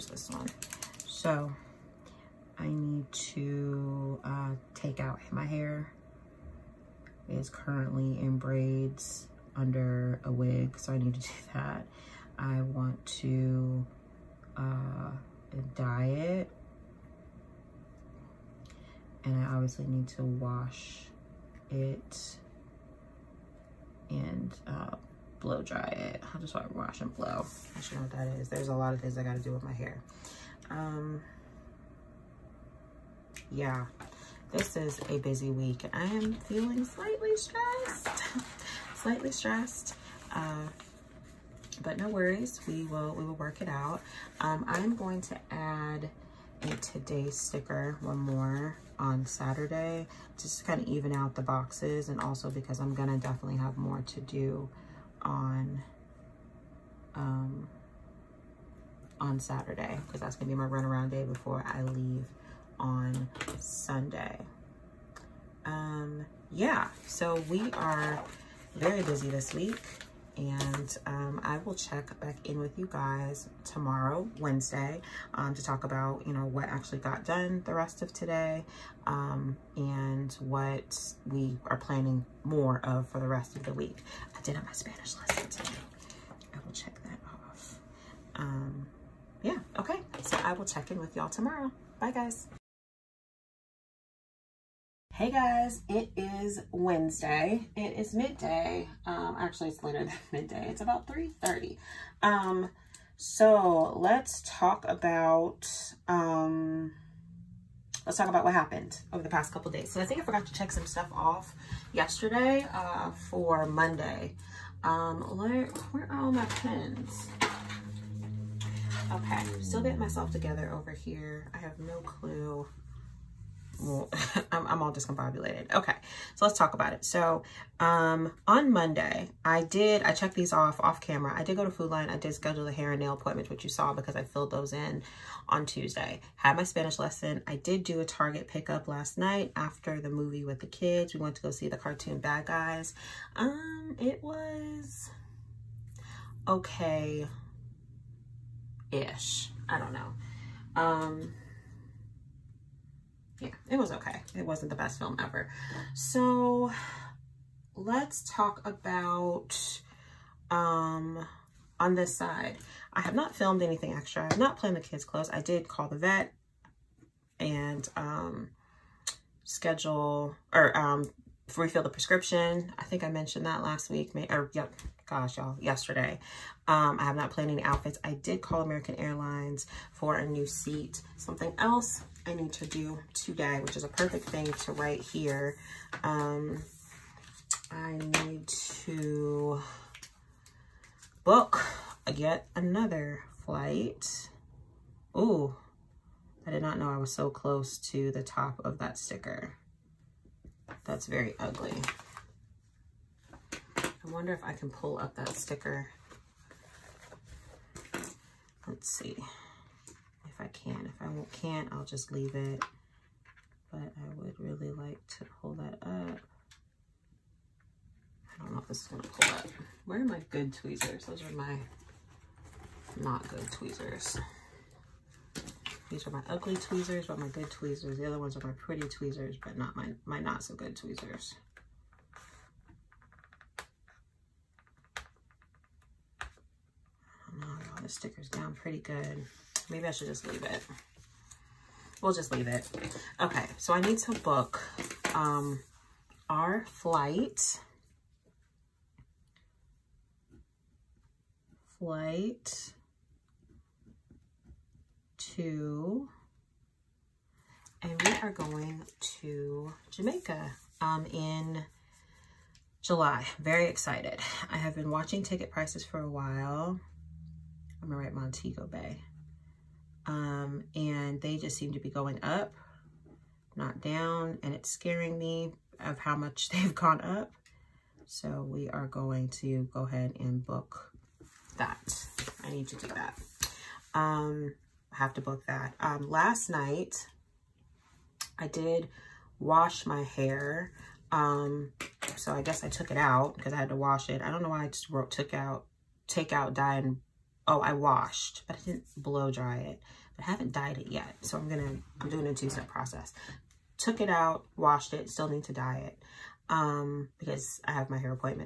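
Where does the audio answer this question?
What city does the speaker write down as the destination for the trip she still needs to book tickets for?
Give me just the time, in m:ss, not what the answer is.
4:28.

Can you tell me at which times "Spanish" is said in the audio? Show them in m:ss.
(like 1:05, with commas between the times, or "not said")
1:24, 2:16.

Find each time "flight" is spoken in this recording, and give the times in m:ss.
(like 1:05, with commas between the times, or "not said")
3:13, 4:06, 4:11.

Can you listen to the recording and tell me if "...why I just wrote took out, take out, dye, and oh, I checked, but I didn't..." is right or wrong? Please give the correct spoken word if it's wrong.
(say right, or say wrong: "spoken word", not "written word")
wrong: "washed", not "checked".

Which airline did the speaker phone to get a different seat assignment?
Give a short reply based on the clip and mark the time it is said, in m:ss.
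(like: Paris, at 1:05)
American Airlines, at 2:58.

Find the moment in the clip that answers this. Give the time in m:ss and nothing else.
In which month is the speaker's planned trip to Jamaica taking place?
4:22.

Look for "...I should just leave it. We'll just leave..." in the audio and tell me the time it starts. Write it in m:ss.
3:59.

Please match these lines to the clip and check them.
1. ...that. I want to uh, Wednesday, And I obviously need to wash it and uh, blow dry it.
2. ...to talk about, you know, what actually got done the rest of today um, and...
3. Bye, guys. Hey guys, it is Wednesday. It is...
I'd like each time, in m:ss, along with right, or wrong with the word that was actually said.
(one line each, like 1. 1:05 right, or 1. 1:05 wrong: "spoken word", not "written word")
1. 0:11 wrong: "Diet", not "Wednesday"
2. 1:15 right
3. 1:31 right.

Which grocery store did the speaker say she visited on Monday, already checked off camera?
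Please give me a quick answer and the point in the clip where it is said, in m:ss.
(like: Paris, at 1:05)
Food Lion, at 2:11.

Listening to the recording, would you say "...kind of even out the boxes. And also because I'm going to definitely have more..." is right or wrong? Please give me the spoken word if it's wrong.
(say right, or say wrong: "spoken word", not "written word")
right.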